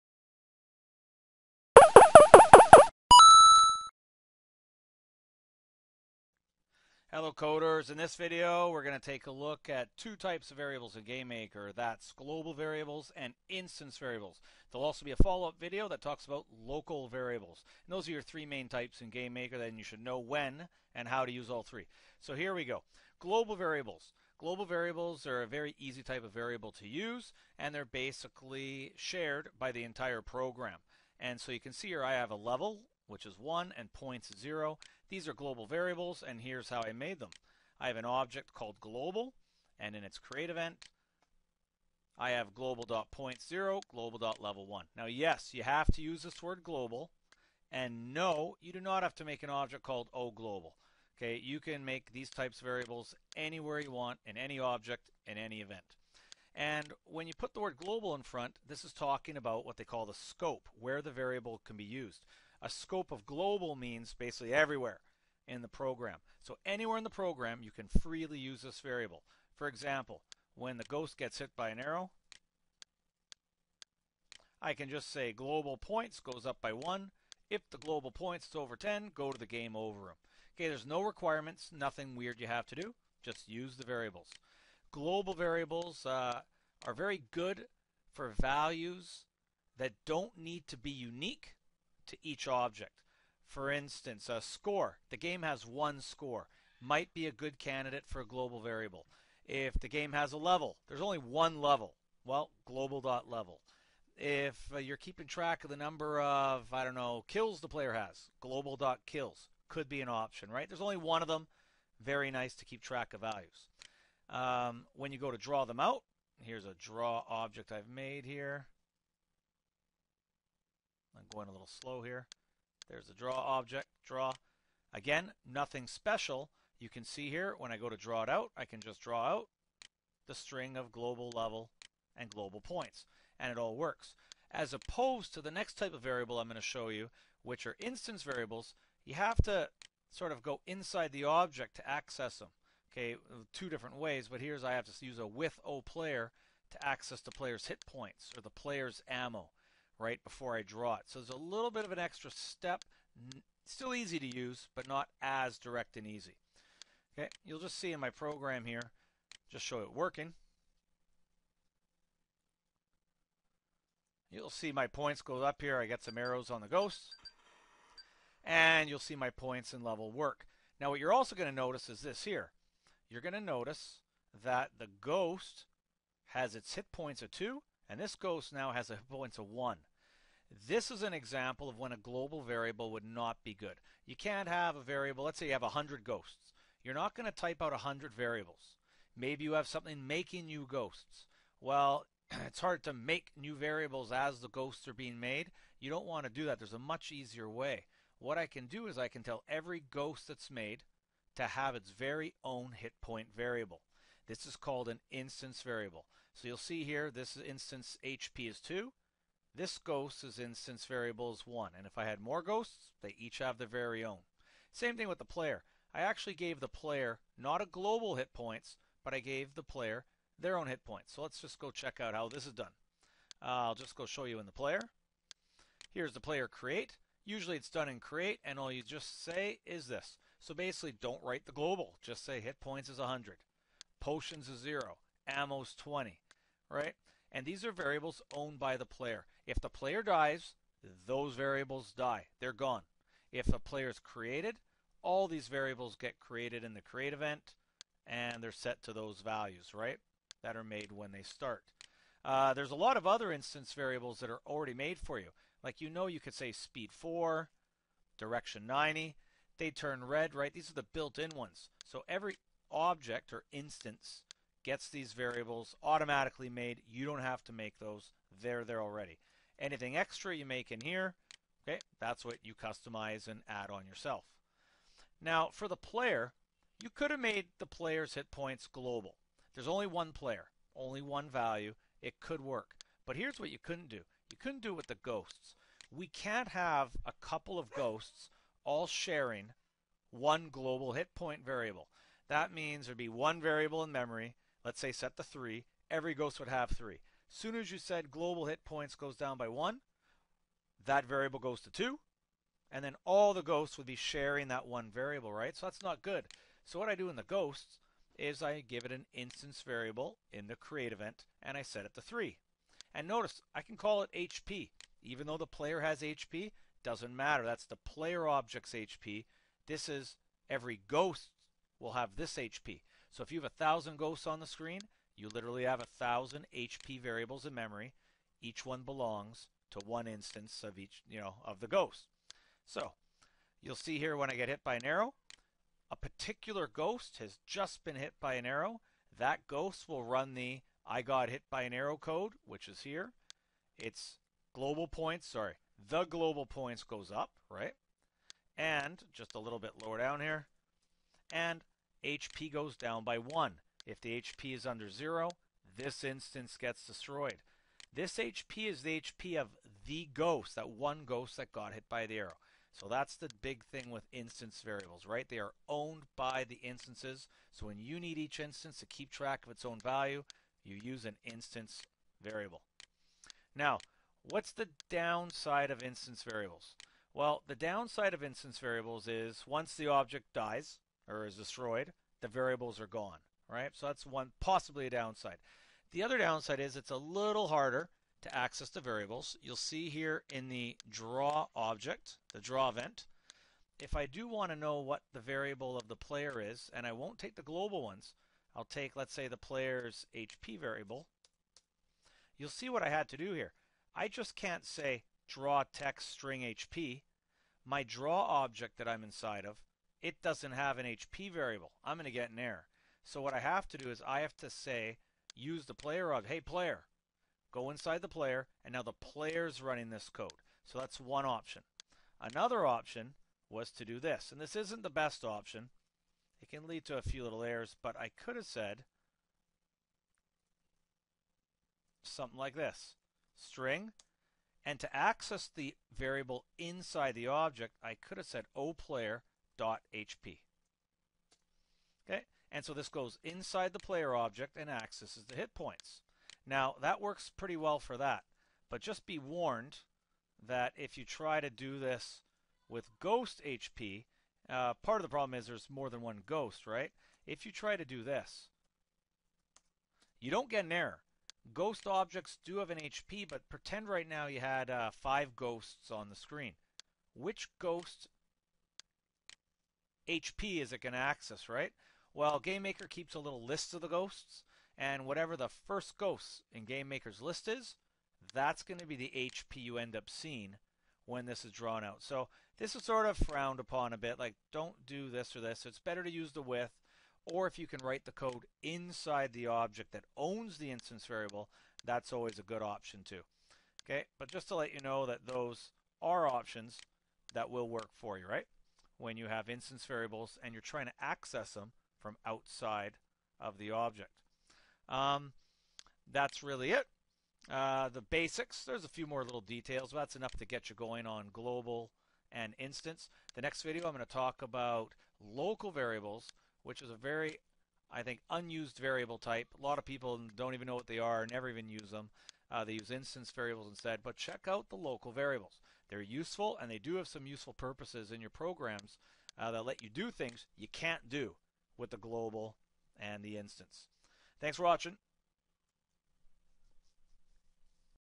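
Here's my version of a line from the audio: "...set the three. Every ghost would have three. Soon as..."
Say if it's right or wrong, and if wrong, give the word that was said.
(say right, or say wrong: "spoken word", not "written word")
right.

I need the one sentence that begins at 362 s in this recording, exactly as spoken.
So that's the big thing with instance variables, right?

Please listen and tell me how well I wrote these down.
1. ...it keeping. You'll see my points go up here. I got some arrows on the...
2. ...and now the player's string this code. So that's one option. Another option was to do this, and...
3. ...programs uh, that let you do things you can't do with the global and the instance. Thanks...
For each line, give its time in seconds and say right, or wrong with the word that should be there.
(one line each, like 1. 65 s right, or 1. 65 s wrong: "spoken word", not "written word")
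1. 159 s wrong: "working", not "keeping"
2. 418 s wrong: "running", not "string"
3. 528 s right.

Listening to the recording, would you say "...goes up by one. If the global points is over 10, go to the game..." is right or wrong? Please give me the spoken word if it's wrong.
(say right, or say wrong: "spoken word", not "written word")
right.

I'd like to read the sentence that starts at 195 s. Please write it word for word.
You don't want to do that.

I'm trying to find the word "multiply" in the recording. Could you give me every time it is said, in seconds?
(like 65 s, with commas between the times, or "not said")
not said.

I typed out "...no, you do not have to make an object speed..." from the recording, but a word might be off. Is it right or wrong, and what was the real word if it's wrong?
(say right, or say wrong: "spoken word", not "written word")
wrong: "called", not "speed".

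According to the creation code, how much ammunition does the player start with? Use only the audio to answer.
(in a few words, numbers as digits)
20.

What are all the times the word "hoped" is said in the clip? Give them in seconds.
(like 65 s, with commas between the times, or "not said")
not said.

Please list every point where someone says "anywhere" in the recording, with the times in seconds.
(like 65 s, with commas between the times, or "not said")
53 s, 66 s.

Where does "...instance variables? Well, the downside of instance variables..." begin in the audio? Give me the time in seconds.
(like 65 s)
375 s.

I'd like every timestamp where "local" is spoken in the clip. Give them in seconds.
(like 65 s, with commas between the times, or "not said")
16 s, 515 s, 524 s.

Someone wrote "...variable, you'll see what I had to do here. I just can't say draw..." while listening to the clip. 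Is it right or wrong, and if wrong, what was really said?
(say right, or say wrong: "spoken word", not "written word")
right.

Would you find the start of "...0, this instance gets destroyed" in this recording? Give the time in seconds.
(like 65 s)
354 s.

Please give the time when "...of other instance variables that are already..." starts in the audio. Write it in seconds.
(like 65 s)
252 s.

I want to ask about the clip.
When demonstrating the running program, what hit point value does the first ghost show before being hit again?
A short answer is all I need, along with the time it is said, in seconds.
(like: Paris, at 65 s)
2, at 176 s.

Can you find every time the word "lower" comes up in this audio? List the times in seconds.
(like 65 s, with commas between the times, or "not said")
349 s.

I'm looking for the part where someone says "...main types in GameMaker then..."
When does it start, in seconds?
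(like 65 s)
18 s.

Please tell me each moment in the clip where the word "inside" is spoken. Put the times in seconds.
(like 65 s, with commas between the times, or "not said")
140 s, 409 s, 417 s, 436 s, 443 s, 488 s.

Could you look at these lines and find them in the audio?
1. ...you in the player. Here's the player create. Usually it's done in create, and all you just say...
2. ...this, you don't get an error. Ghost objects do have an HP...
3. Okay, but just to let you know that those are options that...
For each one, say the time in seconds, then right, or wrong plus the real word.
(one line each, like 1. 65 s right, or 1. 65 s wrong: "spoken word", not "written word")
1. 224 s right
2. 458 s right
3. 493 s right.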